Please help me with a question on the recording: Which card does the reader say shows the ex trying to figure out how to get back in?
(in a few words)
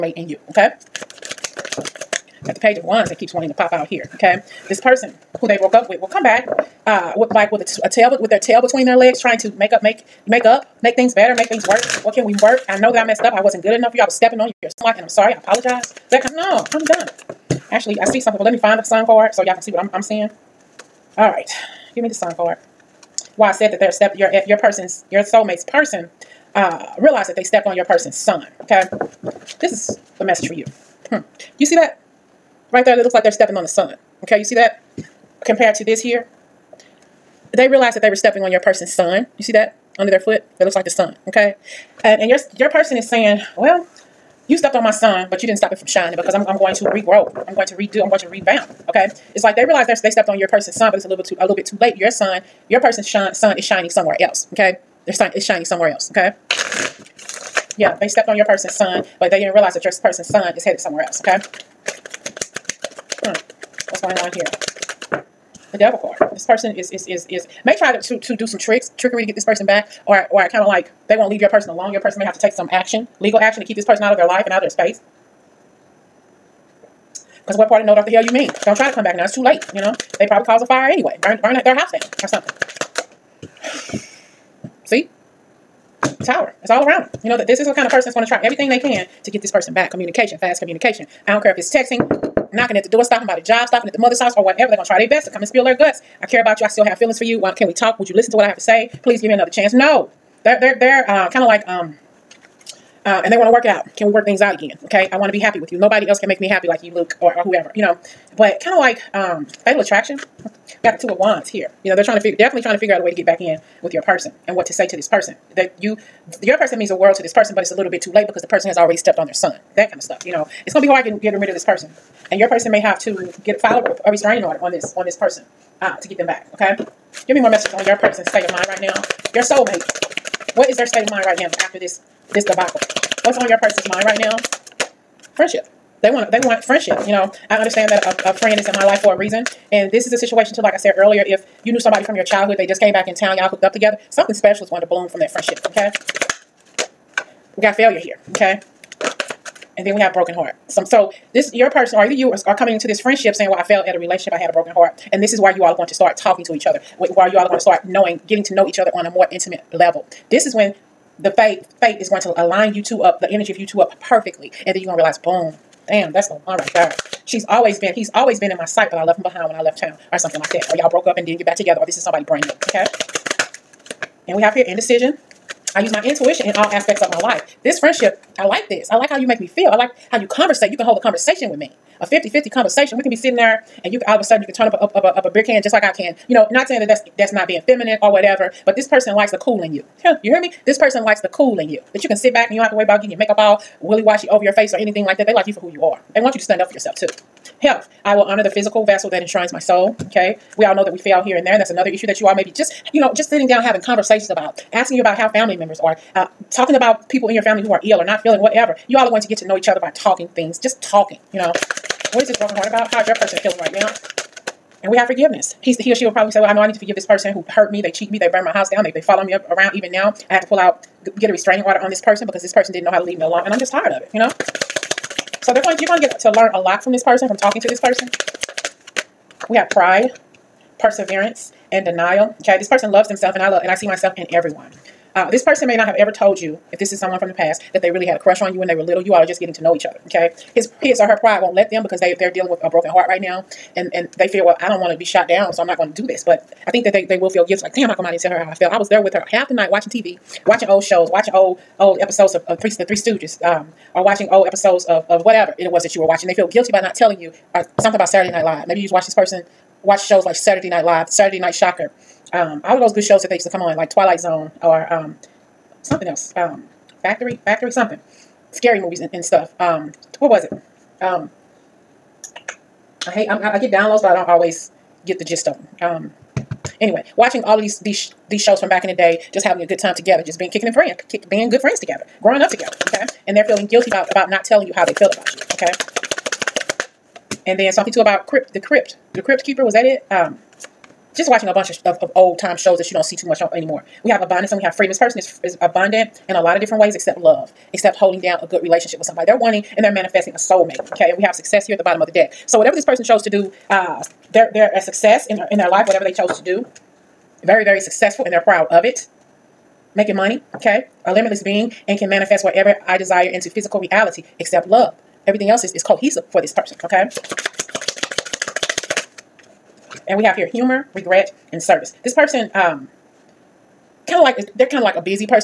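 Two of Wands.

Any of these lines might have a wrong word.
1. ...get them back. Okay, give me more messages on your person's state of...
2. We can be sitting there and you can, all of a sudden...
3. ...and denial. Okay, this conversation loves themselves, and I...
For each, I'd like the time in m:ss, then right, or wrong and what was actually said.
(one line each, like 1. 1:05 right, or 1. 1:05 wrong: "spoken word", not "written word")
1. 2:06 right
2. 3:02 right
3. 3:51 wrong: "person", not "conversation".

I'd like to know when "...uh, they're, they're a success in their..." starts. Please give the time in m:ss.
5:03.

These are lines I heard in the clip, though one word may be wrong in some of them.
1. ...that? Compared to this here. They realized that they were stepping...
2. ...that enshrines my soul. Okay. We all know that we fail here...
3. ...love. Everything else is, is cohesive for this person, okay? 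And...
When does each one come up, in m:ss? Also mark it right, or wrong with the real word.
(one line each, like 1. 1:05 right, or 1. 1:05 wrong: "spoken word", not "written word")
1. 0:34 right
2. 3:19 right
3. 5:14 right.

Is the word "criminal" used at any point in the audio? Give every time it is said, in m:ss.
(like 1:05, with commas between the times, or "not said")
not said.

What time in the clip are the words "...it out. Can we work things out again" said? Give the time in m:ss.
1:43.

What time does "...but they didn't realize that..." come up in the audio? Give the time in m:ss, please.
0:59.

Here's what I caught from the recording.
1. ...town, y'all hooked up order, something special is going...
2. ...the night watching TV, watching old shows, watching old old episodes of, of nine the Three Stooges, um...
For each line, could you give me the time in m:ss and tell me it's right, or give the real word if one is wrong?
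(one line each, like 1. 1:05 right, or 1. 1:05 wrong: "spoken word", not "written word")
1. 2:23 wrong: "together", not "order"
2. 4:09 wrong: "three", not "nine".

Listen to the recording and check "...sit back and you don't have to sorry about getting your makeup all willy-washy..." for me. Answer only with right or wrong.
wrong.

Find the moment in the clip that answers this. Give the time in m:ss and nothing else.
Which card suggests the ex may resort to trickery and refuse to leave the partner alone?
1:05.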